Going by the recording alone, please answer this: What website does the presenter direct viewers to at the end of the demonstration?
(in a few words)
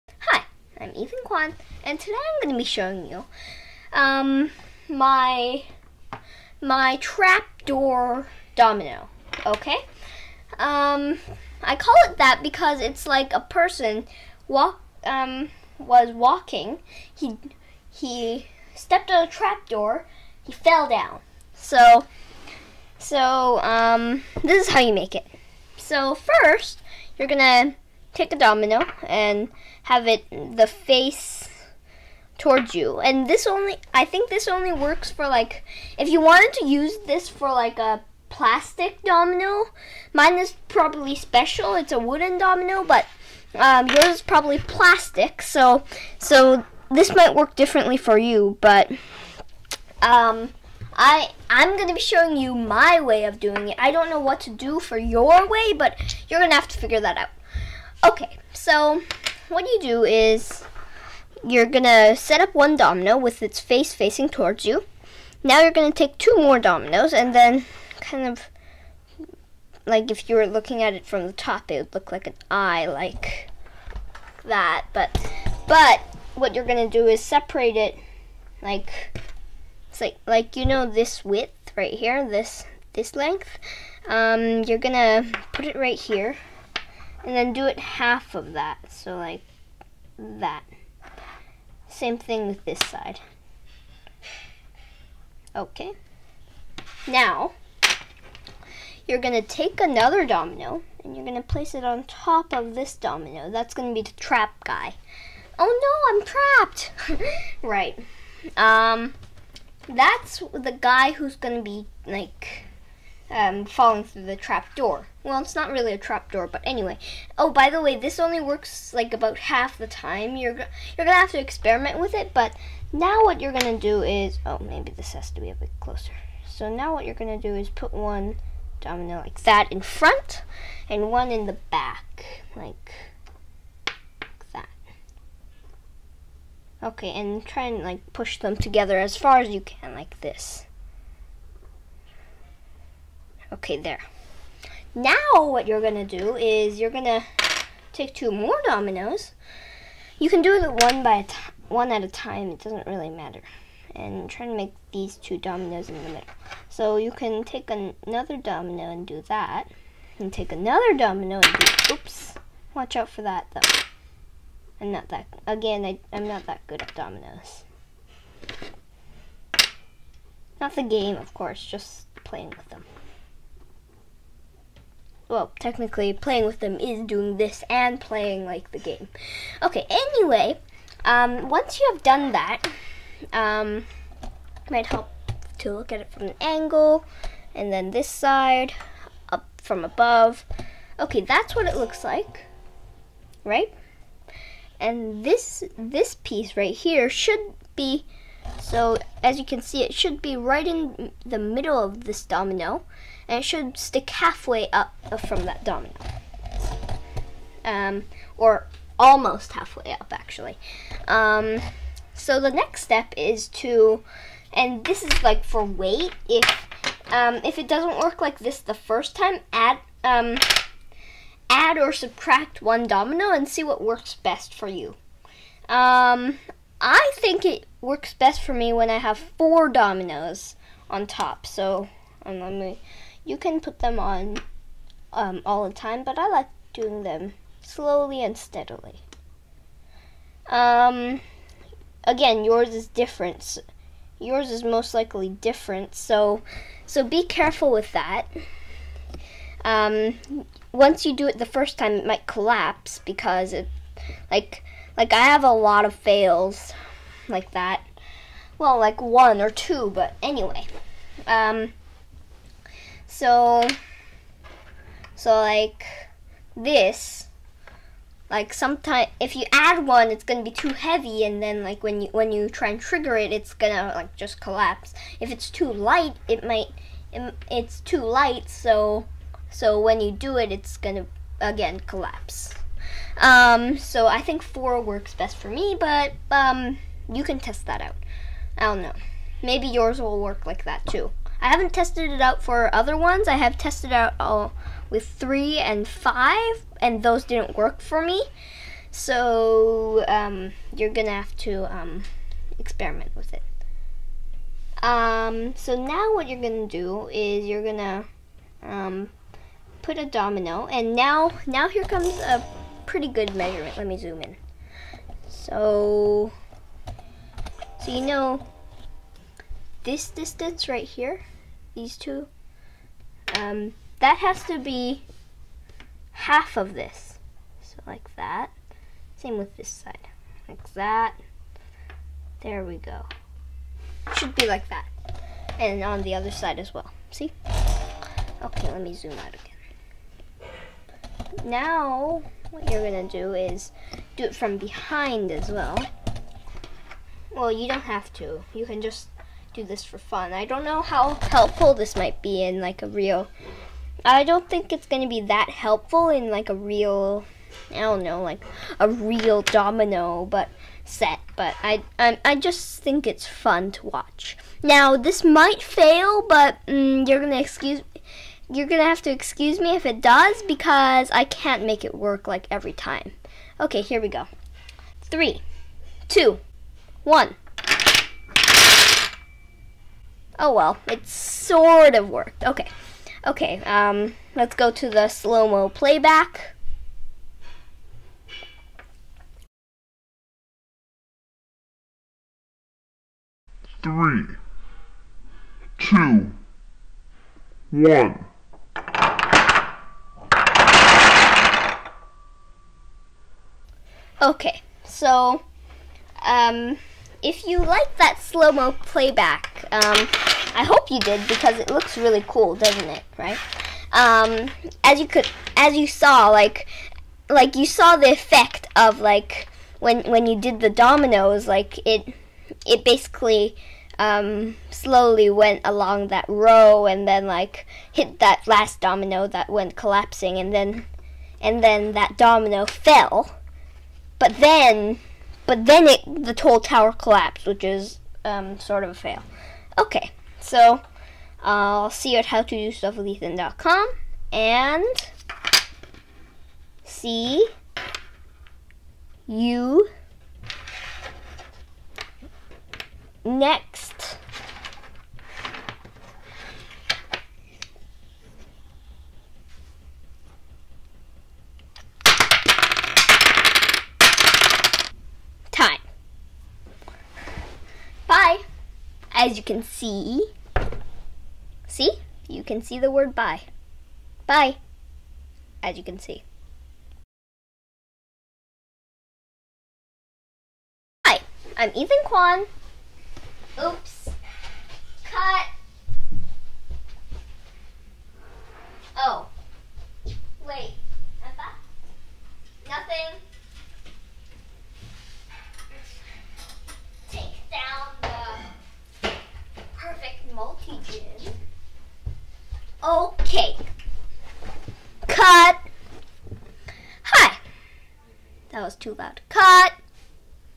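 howtodostuffwithethan.com.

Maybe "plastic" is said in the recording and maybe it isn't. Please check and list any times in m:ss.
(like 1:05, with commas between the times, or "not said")
0:38, 0:44.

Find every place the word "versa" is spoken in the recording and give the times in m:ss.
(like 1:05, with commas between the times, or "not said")
not said.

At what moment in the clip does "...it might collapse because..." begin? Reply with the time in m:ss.
4:11.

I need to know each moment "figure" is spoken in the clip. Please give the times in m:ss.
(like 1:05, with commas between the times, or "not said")
0:56.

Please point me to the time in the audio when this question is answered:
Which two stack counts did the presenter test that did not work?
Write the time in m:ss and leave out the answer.
4:55.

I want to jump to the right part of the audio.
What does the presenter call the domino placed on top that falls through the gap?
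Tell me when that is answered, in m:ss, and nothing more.
1:44.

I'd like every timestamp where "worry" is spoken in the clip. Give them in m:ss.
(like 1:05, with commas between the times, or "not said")
not said.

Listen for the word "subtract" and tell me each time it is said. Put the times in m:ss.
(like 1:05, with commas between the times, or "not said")
3:41.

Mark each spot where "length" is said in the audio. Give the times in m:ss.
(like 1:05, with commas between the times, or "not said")
1:23.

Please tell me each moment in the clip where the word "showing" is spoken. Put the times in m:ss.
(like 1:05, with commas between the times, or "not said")
0:02, 0:51.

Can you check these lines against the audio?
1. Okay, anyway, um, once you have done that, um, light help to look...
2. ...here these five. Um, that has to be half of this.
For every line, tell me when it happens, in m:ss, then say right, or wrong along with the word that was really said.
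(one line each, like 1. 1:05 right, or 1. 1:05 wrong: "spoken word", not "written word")
1. 2:59 wrong: "might", not "light"
2. 5:20 wrong: "two", not "five".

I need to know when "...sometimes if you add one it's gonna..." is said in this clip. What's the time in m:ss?
4:28.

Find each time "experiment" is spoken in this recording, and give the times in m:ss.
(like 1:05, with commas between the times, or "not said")
2:01, 5:02.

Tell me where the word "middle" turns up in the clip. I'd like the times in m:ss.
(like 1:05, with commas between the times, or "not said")
2:36, 3:21.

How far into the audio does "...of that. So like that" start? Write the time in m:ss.
1:28.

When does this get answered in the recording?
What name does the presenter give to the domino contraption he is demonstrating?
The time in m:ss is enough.
0:06.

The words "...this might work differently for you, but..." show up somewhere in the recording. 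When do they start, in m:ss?
0:46.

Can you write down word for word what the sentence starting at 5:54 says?
I don't think it's going to be that helpful in like a real.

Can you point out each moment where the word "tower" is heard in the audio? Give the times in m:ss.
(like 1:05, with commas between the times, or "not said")
7:16.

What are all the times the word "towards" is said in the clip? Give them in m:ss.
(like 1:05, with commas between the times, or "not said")
0:32, 1:04.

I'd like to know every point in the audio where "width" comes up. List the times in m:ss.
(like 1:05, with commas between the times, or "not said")
1:21.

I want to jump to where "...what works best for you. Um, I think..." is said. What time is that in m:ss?
3:43.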